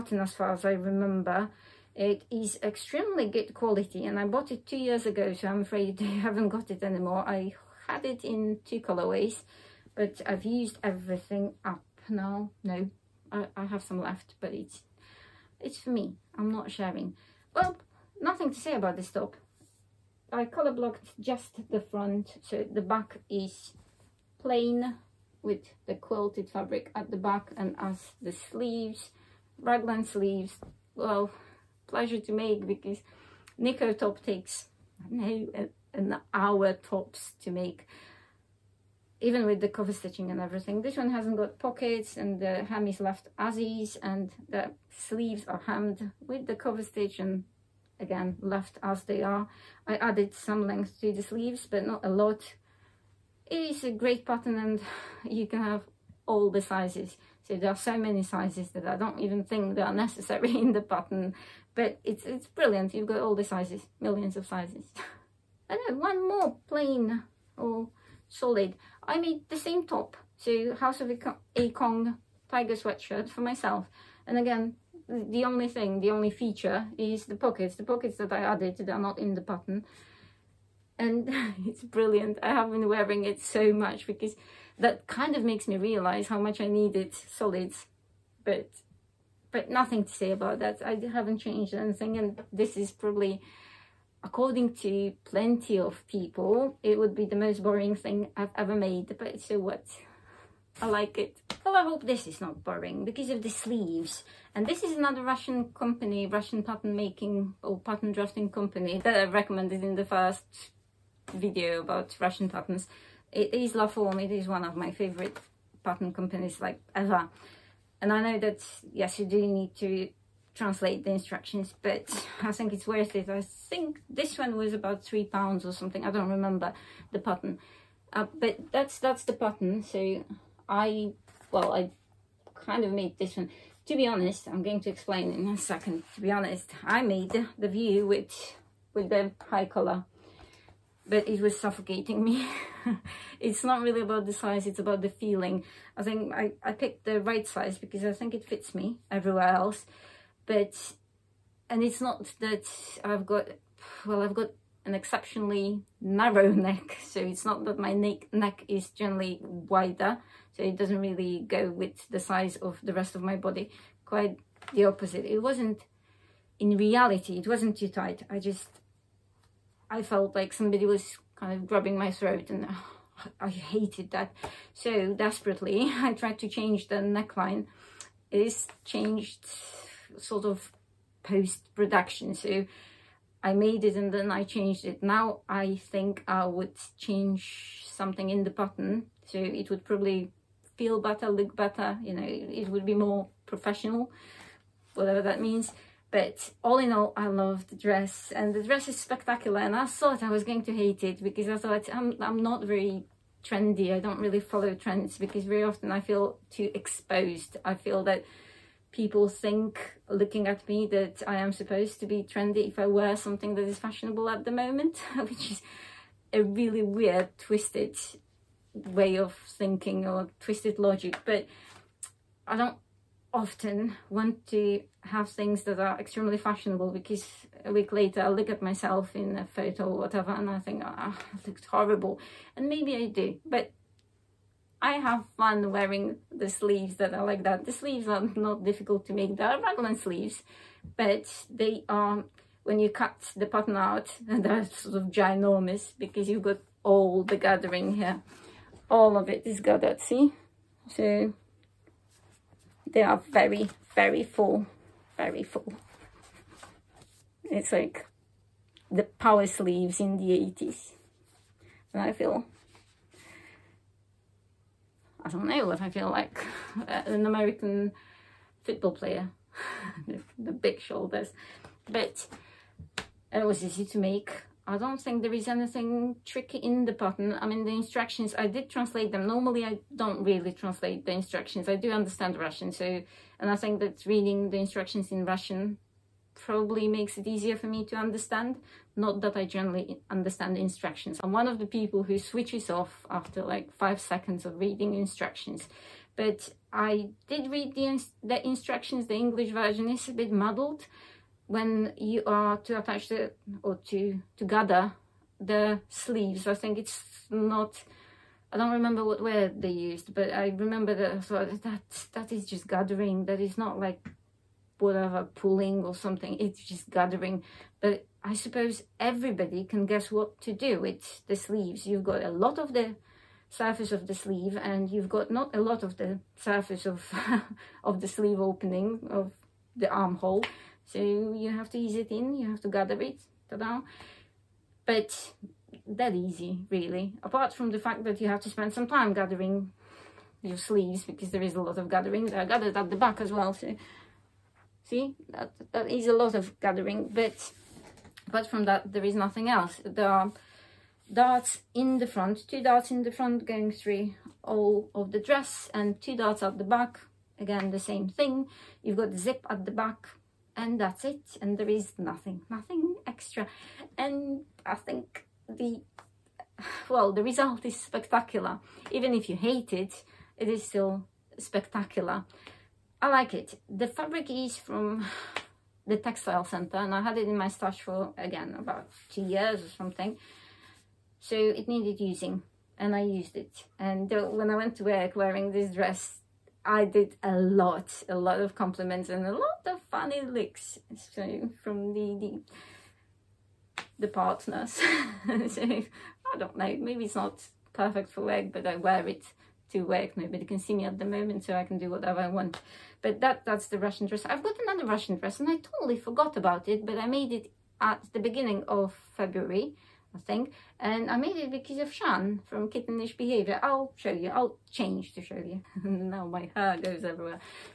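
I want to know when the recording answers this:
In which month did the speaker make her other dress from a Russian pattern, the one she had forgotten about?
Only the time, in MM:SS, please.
06:49.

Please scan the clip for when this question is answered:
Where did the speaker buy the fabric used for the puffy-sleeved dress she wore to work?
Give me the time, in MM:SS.
06:15.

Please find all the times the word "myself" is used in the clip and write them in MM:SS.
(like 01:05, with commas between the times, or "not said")
01:13, 03:48.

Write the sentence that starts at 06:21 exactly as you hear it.
So it needed using and I used it.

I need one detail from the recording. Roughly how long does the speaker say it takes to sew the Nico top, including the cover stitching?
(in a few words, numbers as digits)
an hour.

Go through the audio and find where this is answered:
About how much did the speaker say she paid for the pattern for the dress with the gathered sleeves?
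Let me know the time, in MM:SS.
02:05.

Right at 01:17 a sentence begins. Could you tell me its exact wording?
The pockets that I added that are not in the pattern.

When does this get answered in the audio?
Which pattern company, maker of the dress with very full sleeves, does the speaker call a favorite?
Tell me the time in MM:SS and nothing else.
01:53.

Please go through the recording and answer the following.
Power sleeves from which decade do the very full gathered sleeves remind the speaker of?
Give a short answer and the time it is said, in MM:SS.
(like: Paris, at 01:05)
the 80s, at 04:20.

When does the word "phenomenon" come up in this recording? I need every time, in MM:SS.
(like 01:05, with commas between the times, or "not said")
not said.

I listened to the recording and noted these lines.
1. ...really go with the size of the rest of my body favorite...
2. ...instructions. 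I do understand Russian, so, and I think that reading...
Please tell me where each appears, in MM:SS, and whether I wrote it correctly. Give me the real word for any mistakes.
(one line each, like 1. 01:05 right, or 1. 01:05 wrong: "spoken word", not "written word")
1. 02:40 wrong: "quite", not "favorite"
2. 04:41 right.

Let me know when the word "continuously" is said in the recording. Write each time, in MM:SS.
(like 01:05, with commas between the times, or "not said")
not said.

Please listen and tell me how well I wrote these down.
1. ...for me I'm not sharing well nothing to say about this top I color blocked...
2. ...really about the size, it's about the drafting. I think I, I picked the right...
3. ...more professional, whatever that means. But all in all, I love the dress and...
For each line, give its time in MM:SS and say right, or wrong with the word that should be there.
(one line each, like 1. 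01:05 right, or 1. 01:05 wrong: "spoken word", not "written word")
1. 00:15 right
2. 02:23 wrong: "feeling", not "drafting"
3. 03:12 right.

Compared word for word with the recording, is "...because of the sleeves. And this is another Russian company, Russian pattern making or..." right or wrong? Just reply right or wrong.
right.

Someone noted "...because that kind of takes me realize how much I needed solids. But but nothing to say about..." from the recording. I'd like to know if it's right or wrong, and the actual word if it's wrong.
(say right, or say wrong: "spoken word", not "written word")
wrong: "makes", not "takes".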